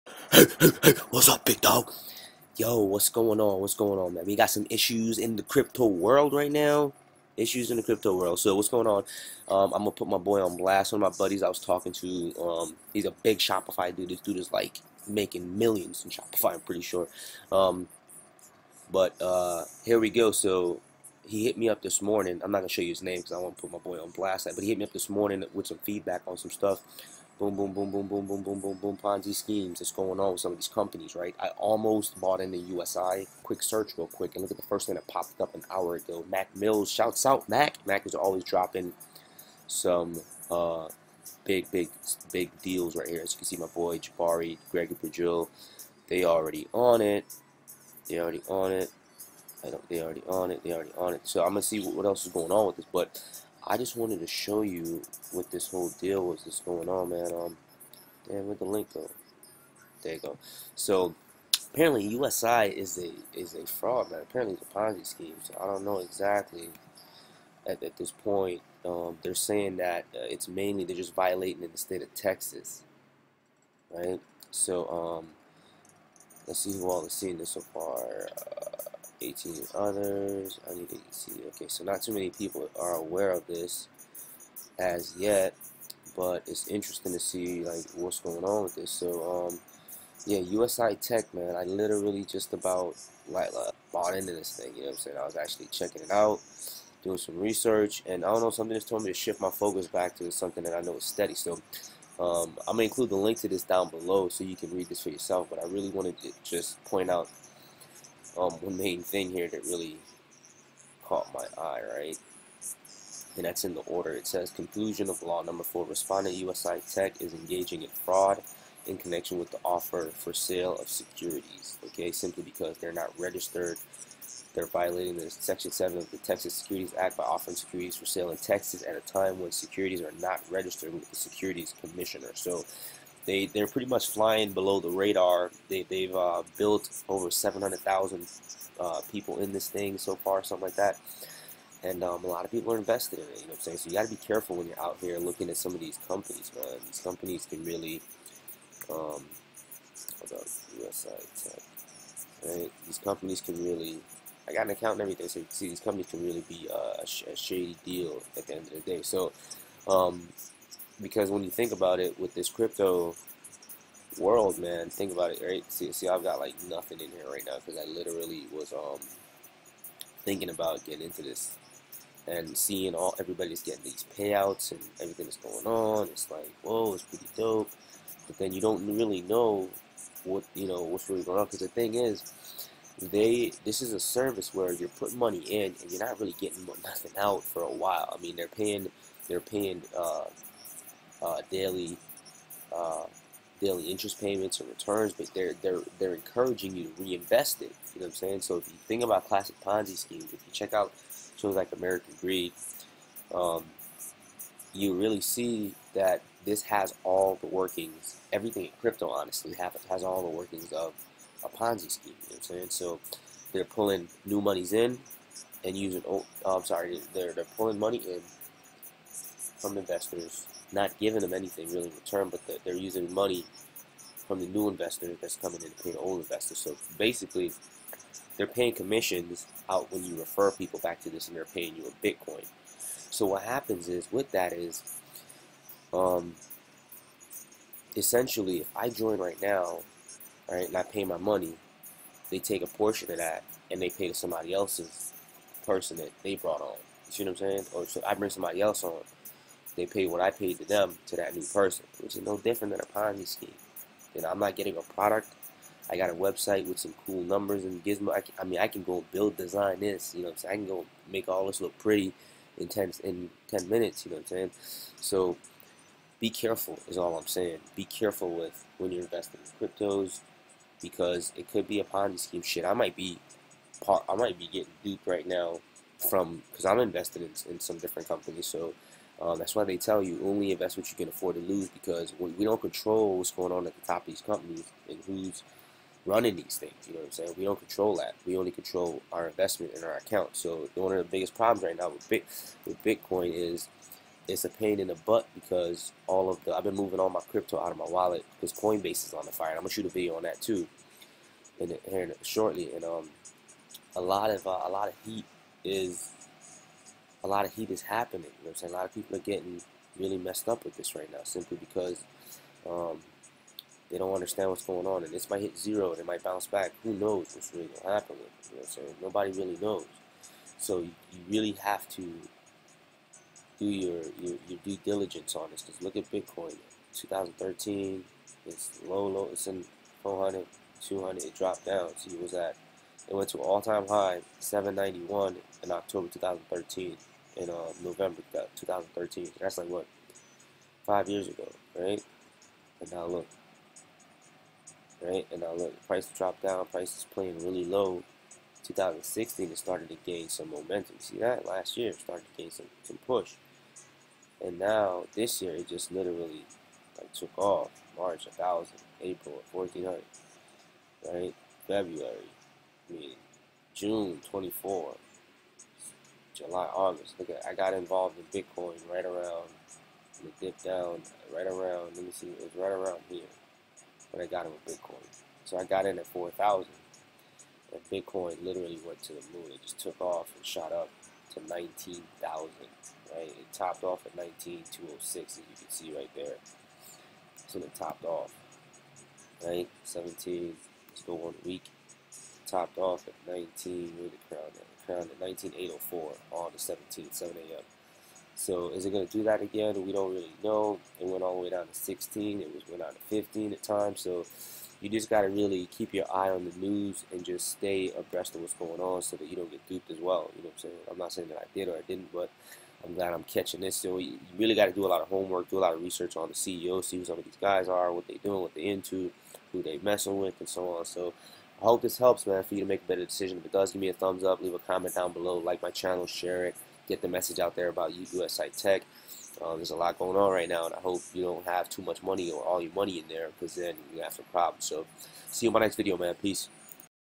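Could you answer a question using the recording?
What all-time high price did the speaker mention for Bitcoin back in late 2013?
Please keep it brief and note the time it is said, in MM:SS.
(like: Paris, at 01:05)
791, at 05:34.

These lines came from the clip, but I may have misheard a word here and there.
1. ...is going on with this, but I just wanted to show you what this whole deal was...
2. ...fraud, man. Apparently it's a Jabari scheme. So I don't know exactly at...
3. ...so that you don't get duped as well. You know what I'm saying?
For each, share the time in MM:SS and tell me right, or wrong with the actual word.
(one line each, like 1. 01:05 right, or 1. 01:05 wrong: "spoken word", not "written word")
1. 00:52 right
2. 01:03 wrong: "Ponzi", not "Jabari"
3. 06:49 right.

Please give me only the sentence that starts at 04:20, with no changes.
You know, so i can go make all this look pretty in ten in ten minutes.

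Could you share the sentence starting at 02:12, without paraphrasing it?
So they they're pretty much flying below the radar.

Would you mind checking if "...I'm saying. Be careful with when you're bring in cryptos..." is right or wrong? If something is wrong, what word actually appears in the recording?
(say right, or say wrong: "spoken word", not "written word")
wrong: "investing", not "bring".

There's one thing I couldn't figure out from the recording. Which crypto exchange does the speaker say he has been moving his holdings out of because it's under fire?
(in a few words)
Coinbase.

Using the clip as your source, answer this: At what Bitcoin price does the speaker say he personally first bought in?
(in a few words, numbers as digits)
4,000.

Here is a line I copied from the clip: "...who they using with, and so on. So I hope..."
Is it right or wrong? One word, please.
wrong.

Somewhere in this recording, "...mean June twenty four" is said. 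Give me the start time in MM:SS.
06:02.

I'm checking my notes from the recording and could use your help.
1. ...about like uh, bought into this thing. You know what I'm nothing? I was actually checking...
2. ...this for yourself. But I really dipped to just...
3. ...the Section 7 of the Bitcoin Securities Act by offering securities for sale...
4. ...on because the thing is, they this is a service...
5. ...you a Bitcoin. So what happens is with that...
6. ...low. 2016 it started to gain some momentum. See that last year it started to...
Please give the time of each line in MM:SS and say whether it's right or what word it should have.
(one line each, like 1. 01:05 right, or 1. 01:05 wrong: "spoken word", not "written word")
1. 01:32 wrong: "saying", not "nothing"
2. 01:44 wrong: "wanted", not "dipped"
3. 02:05 wrong: "Texas", not "Bitcoin"
4. 03:01 right
5. 03:51 right
6. 05:47 right.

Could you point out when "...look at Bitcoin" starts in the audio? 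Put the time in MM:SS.
05:25.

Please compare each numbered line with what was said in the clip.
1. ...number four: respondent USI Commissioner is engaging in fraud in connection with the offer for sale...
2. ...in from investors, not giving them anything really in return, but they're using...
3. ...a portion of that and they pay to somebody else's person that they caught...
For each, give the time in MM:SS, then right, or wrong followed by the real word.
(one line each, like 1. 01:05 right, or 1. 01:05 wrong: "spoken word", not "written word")
1. 01:55 wrong: "Tech", not "Commissioner"
2. 03:37 right
3. 04:02 wrong: "brought", not "caught".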